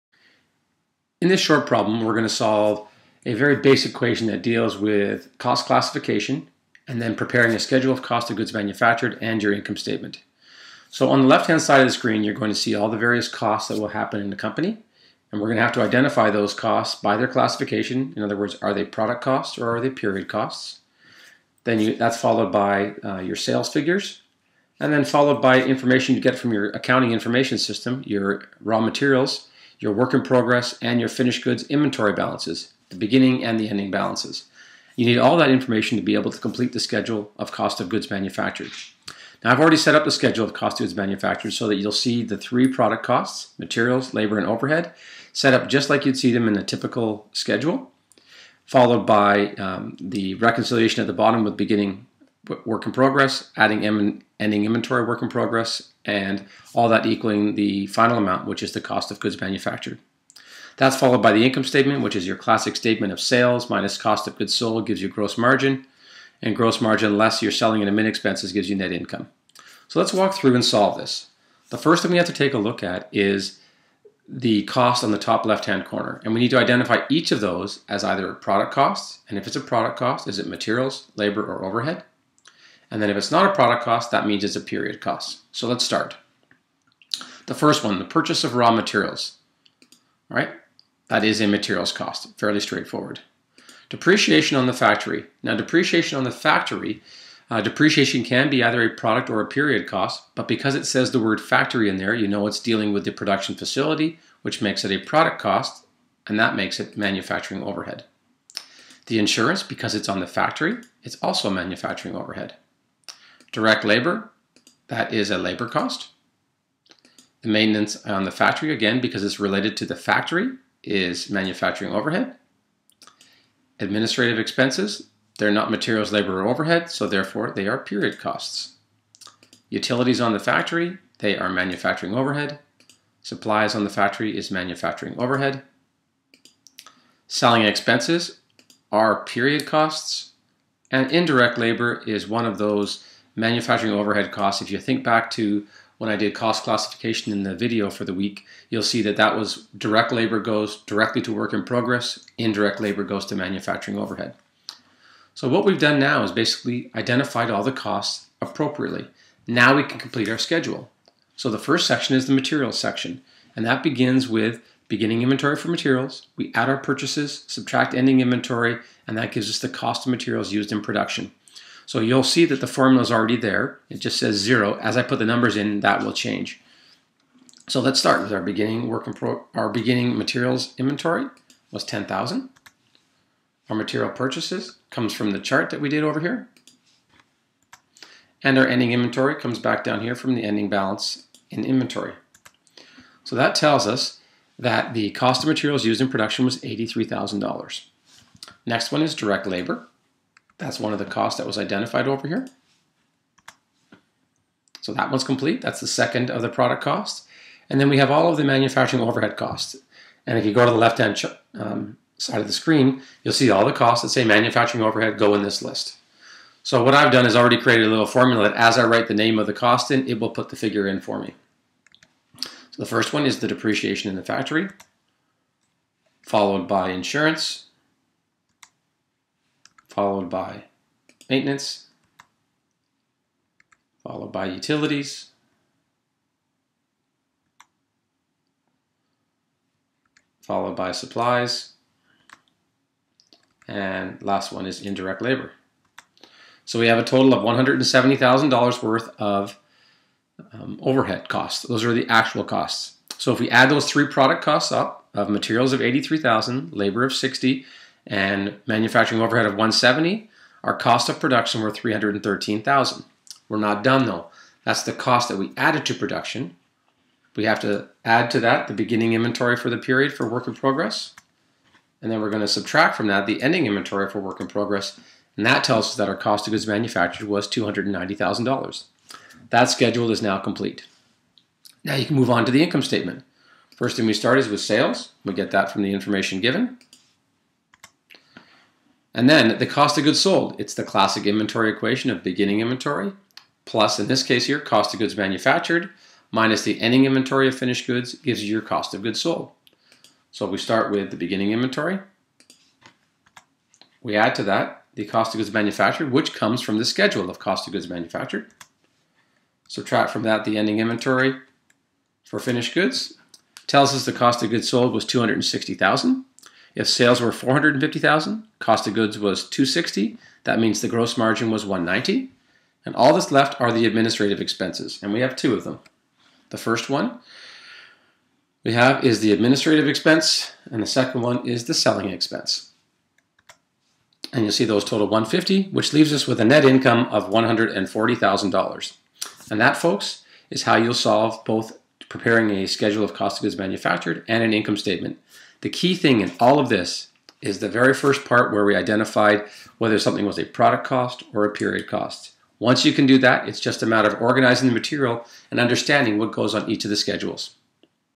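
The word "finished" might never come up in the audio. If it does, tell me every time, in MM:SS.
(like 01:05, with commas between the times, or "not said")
00:31, 04:57, 05:12.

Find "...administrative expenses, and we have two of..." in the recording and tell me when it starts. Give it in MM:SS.
05:23.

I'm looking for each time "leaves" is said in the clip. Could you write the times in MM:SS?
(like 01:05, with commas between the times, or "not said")
05:35.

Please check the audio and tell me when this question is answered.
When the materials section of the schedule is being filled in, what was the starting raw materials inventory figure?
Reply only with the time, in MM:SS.
03:01.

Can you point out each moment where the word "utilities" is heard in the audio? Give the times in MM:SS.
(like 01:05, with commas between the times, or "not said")
02:09, 03:54.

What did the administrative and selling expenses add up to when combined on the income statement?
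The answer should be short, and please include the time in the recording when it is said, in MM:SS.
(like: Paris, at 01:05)
150, at 05:35.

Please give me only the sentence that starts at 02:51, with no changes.
So you'll see that the formula is already there.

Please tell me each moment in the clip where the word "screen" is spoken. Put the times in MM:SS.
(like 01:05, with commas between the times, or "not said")
00:11, 03:32.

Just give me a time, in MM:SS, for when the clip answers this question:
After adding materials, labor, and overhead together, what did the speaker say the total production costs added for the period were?
04:21.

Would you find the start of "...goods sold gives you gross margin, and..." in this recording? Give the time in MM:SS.
01:04.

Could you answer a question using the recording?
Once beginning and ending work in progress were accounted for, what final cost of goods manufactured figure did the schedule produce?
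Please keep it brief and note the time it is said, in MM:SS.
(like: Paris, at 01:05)
$290,000, at 04:37.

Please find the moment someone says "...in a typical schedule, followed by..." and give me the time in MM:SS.
00:46.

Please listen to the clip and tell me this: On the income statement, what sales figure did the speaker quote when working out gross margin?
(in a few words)
450,000.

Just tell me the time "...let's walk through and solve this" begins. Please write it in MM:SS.
01:09.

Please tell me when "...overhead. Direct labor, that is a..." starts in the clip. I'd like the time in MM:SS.
01:52.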